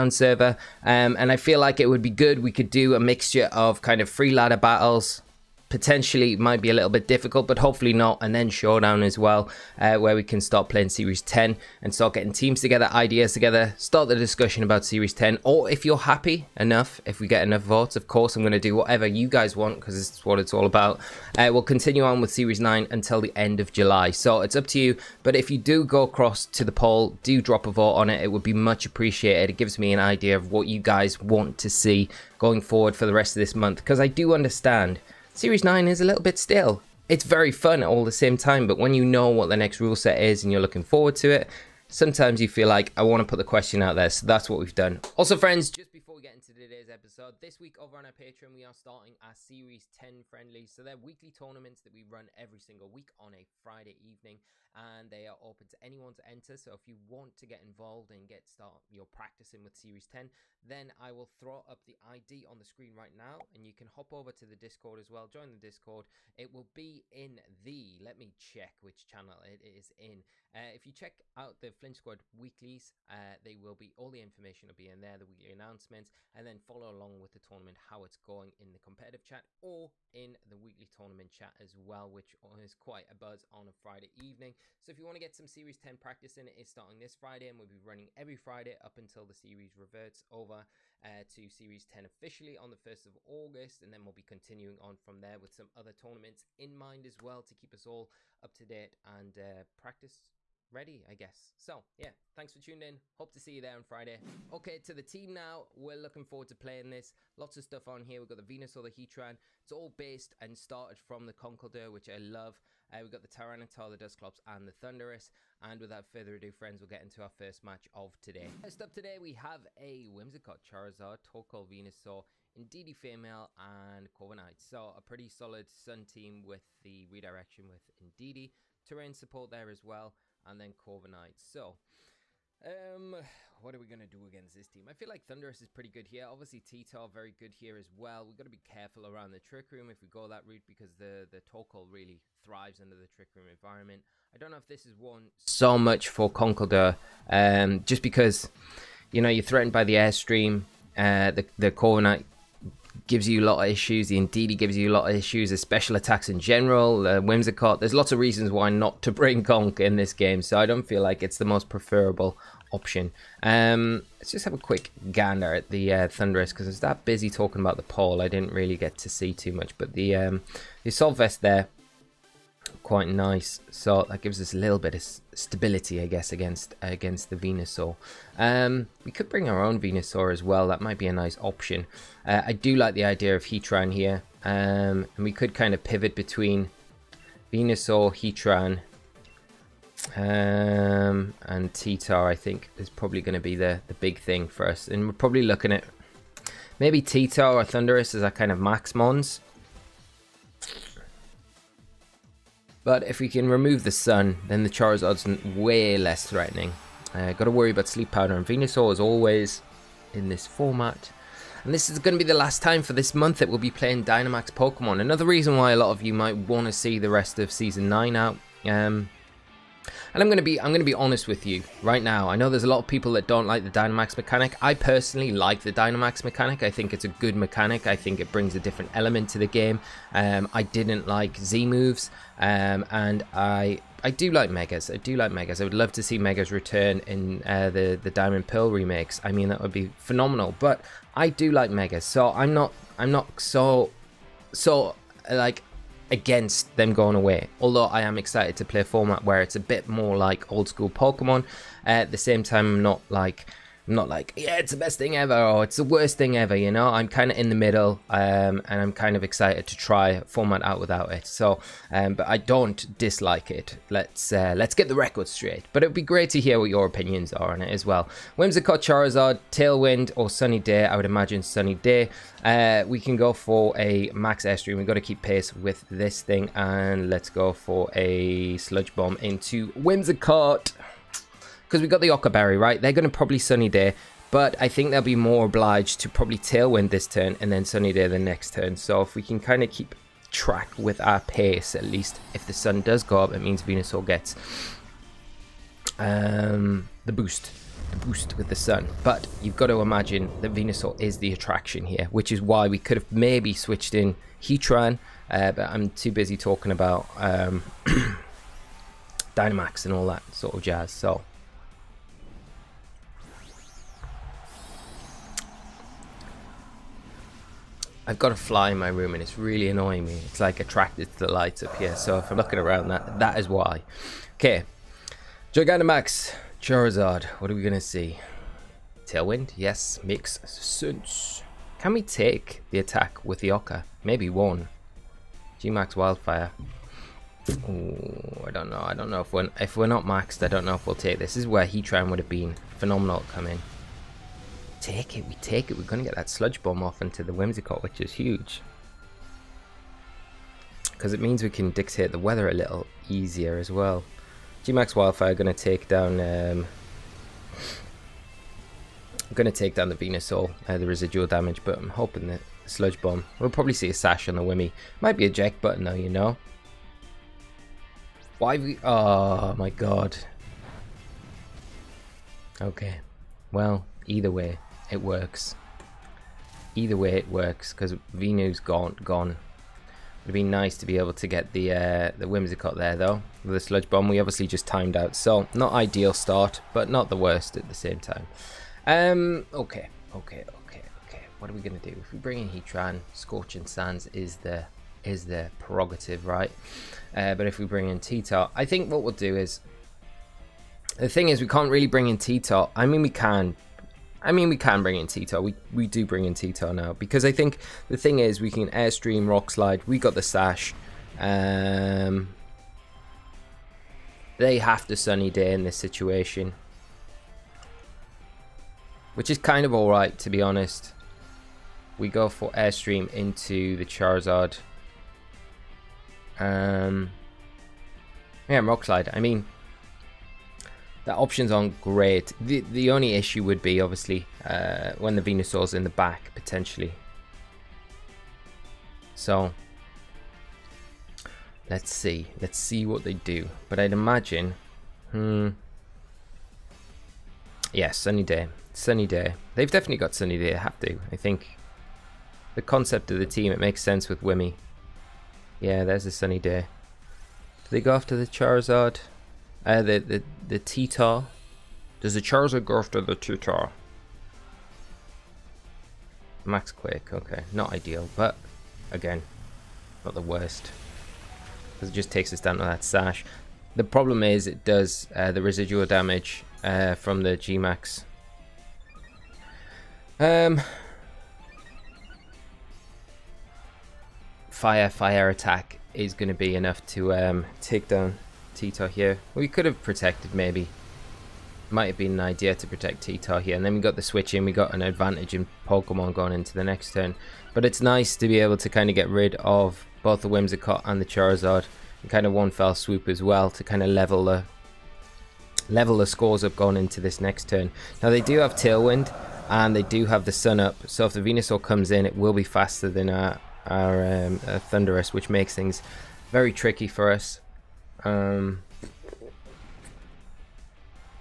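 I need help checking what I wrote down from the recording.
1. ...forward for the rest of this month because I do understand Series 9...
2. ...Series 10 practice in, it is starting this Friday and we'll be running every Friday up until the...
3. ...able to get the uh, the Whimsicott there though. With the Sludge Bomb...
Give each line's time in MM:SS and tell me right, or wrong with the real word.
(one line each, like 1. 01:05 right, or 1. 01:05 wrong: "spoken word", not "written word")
1. 00:32 right
2. 01:25 right
3. 06:20 right.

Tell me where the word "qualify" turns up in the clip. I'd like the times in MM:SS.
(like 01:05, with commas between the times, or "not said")
not said.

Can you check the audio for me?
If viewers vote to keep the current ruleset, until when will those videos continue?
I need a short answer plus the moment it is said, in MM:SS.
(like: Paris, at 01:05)
End of July, at 00:23.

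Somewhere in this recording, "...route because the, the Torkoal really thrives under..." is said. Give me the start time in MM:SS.
02:20.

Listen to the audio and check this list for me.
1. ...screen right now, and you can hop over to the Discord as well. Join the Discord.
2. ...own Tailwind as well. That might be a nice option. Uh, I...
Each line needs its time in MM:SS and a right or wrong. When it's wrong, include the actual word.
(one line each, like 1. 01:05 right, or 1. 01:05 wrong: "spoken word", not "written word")
1. 01:02 right
2. 02:59 wrong: "Venusaur", not "Tailwind".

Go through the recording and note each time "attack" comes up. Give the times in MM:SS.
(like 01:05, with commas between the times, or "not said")
02:35, 05:32, 08:05.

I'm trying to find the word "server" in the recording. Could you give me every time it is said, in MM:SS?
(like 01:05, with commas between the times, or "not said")
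00:00.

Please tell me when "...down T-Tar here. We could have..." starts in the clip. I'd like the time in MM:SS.
08:07.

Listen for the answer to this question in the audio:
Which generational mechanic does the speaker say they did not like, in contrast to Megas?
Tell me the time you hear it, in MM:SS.
03:51.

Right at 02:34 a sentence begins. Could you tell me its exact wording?
The Indeedee gives you a lot of issues.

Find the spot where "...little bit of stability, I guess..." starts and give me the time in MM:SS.
02:54.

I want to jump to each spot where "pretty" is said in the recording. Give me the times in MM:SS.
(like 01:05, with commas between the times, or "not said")
02:05, 02:15.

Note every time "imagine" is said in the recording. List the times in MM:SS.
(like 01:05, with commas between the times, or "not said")
04:31, 04:59, 07:23.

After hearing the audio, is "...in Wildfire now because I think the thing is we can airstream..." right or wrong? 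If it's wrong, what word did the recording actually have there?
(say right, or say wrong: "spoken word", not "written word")
wrong: "Tito", not "Wildfire".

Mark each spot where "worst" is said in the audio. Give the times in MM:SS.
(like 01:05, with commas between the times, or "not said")
04:15, 06:27, 07:50.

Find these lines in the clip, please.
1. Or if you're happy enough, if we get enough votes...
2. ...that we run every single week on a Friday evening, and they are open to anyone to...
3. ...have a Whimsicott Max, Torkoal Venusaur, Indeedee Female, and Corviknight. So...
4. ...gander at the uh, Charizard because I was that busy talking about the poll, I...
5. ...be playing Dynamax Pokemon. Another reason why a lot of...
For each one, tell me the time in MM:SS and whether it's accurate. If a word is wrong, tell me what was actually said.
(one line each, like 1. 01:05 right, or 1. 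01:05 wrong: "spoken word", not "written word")
1. 00:15 right
2. 00:51 right
3. 01:59 wrong: "Charizard", not "Max"
4. 02:45 wrong: "Thundurus", not "Charizard"
5. 03:33 right.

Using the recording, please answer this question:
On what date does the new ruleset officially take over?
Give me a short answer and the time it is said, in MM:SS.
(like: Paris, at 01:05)
1st of August, at 01:32.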